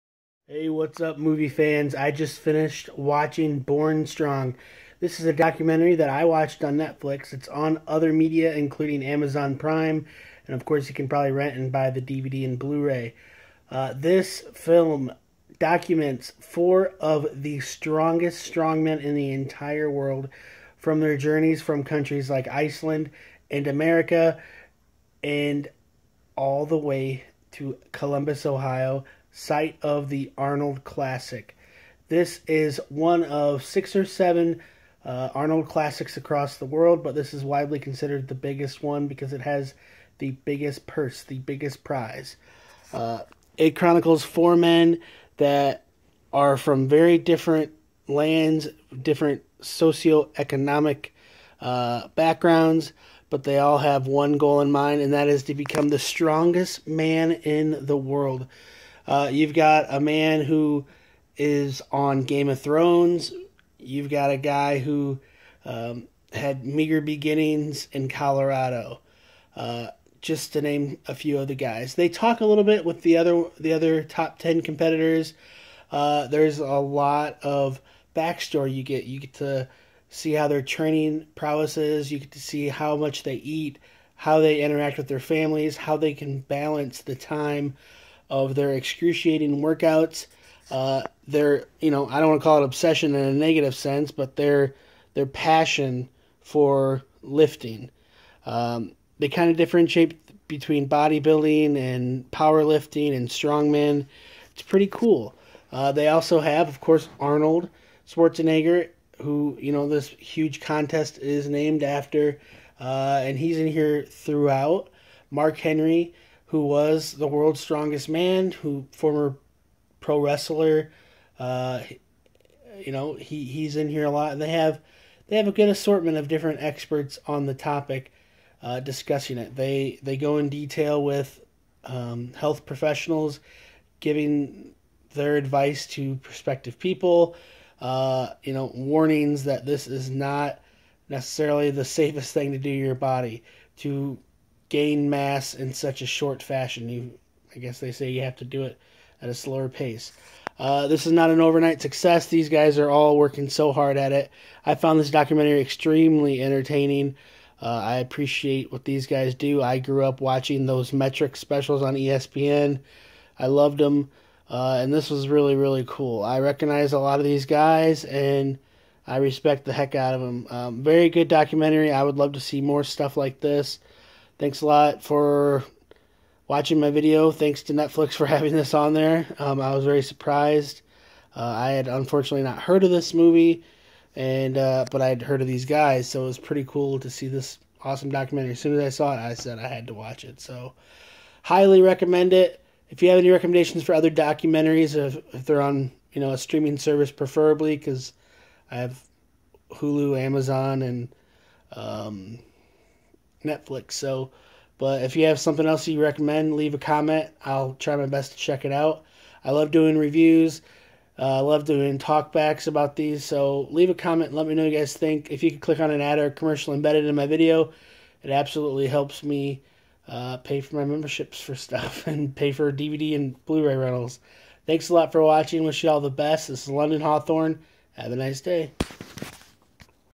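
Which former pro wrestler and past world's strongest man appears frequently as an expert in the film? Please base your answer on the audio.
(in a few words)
Mark Henry.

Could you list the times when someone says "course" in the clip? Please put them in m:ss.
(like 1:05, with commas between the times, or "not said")
0:10, 1:46.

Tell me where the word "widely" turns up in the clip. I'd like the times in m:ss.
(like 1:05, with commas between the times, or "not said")
0:37.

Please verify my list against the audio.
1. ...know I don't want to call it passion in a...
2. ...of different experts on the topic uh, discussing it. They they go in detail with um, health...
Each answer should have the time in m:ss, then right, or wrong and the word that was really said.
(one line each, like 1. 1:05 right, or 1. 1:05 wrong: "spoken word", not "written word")
1. 1:31 wrong: "obsession", not "passion"
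2. 2:06 right.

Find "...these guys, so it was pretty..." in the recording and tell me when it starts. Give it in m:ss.
3:05.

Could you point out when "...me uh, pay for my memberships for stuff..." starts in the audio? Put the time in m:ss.
3:39.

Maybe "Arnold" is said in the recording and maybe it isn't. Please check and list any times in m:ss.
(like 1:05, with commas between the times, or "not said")
0:30, 0:35, 1:47.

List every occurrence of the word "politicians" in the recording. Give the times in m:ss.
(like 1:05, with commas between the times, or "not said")
not said.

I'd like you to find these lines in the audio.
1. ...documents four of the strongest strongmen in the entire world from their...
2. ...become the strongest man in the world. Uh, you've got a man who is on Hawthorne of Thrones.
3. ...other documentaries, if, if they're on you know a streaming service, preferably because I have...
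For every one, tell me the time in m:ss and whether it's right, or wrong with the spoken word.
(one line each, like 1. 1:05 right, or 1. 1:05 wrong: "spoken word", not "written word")
1. 0:15 right
2. 0:55 wrong: "Game", not "Hawthorne"
3. 3:13 right.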